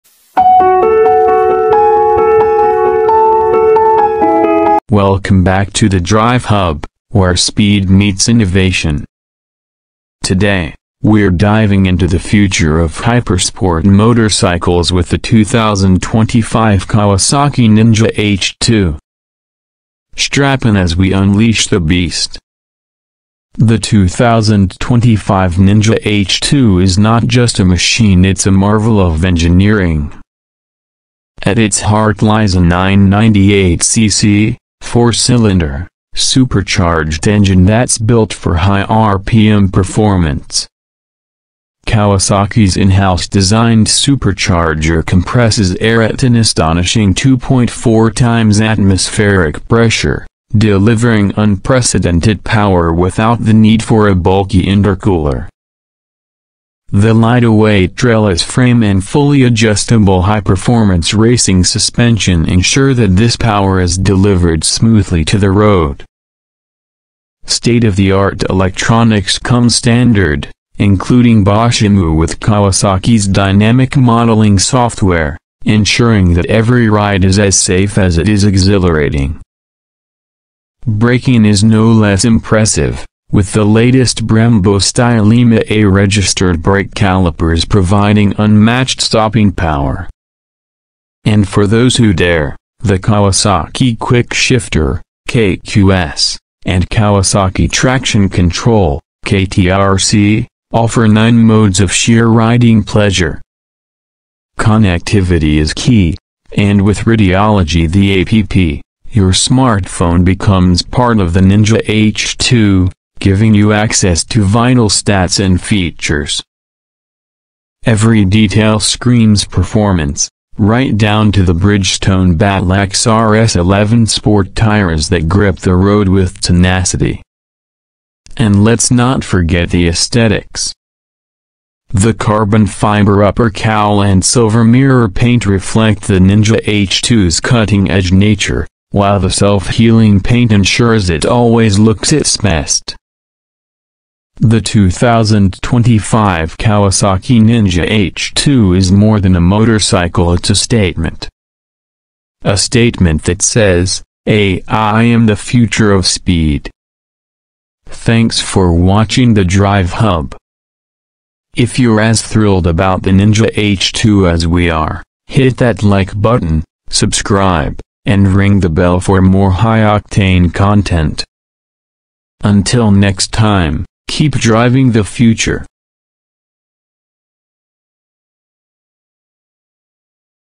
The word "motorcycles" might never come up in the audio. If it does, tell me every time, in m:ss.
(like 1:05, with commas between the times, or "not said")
0:13, 2:29.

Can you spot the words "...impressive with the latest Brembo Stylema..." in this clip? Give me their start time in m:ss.
1:22.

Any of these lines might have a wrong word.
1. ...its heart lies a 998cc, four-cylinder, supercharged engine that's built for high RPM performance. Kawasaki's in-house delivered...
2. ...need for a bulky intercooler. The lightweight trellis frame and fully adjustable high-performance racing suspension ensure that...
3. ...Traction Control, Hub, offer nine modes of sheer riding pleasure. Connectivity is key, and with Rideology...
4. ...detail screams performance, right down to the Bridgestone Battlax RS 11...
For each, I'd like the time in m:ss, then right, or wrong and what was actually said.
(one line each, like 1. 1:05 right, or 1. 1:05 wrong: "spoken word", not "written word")
1. 0:31 wrong: "designed", not "delivered"
2. 0:53 right
3. 1:37 wrong: "KTRC", not "Hub"
4. 1:58 right.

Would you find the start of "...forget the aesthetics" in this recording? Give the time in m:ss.
2:09.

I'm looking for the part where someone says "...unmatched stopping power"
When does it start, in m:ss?
1:28.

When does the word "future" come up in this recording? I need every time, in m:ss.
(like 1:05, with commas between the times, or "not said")
0:12, 2:35, 2:55.